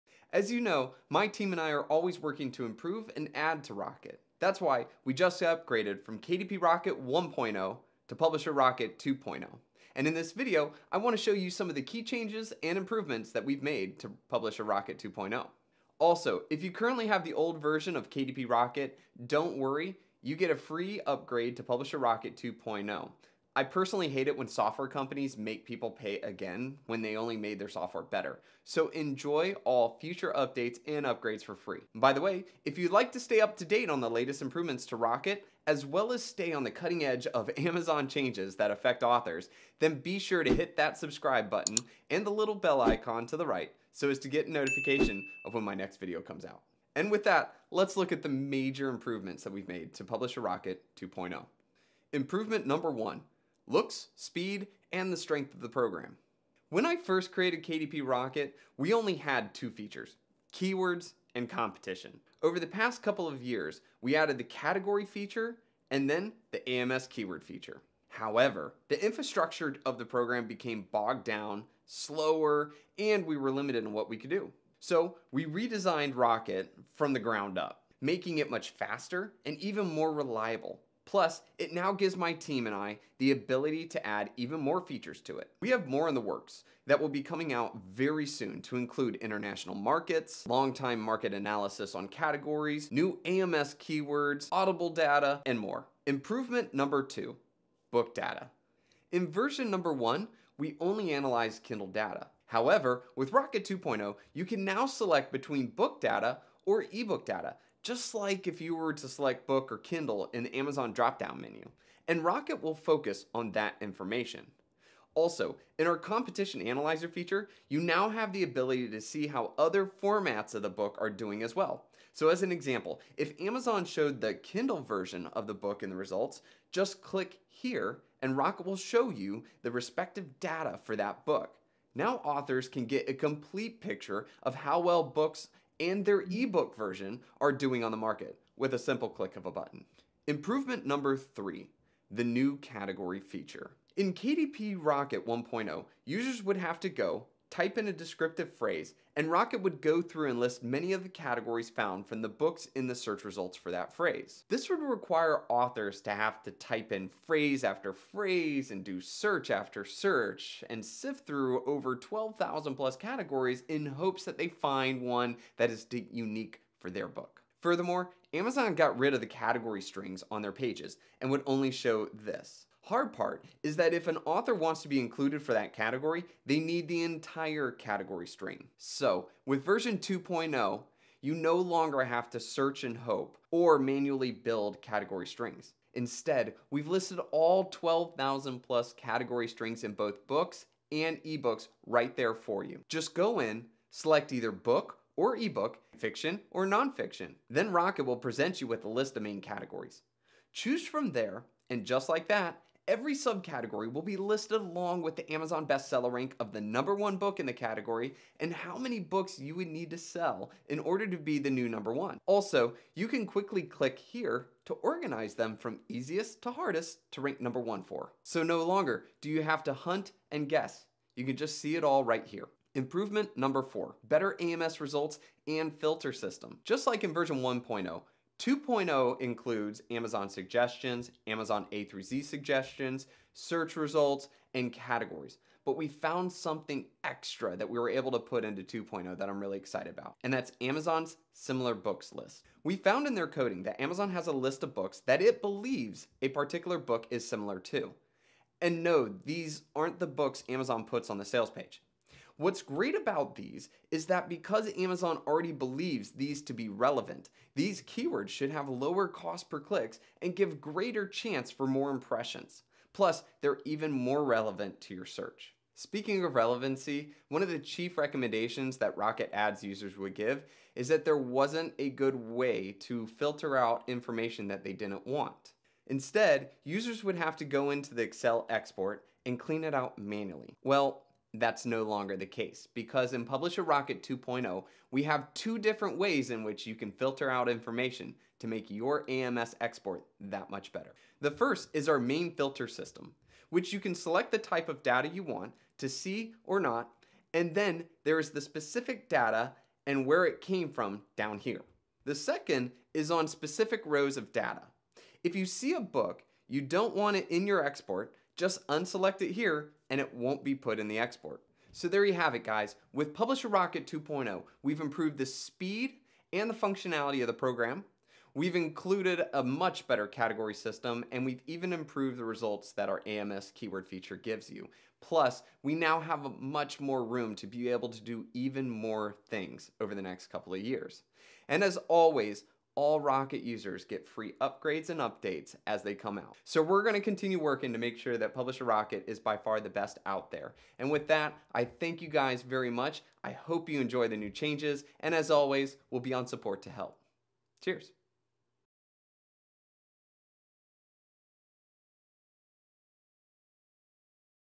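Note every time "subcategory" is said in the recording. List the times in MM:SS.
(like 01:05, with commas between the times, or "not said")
03:23.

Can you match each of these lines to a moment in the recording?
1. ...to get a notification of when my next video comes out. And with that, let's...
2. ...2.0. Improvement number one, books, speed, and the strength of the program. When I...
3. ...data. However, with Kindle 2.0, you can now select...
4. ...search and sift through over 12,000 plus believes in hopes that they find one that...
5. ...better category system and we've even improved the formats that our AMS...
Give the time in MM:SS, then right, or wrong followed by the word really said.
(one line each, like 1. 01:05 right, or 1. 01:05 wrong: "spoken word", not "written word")
1. 00:44 right
2. 00:50 wrong: "looks", not "books"
3. 01:41 wrong: "Rocket", not "Kindle"
4. 02:39 wrong: "categories", not "believes"
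5. 05:19 wrong: "results", not "formats".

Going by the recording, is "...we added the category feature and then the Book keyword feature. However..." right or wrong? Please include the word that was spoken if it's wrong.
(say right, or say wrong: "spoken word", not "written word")
wrong: "AMS", not "Book".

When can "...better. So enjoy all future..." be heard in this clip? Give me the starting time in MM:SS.
00:28.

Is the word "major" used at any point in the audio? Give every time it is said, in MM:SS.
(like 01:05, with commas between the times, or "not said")
00:48.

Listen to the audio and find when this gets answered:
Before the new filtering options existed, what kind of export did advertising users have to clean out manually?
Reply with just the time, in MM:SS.
04:38.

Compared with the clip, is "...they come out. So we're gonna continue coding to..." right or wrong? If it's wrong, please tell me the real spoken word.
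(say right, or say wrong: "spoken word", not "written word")
wrong: "working", not "coding".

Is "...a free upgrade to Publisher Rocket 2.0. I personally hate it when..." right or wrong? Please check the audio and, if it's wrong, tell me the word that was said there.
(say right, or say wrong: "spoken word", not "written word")
right.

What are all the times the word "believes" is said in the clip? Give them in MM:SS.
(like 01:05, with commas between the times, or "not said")
04:05, 04:15.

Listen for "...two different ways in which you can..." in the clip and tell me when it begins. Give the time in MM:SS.
04:45.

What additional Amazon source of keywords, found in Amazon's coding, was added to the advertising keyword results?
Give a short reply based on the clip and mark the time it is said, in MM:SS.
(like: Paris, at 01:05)
Similar books list, at 04:01.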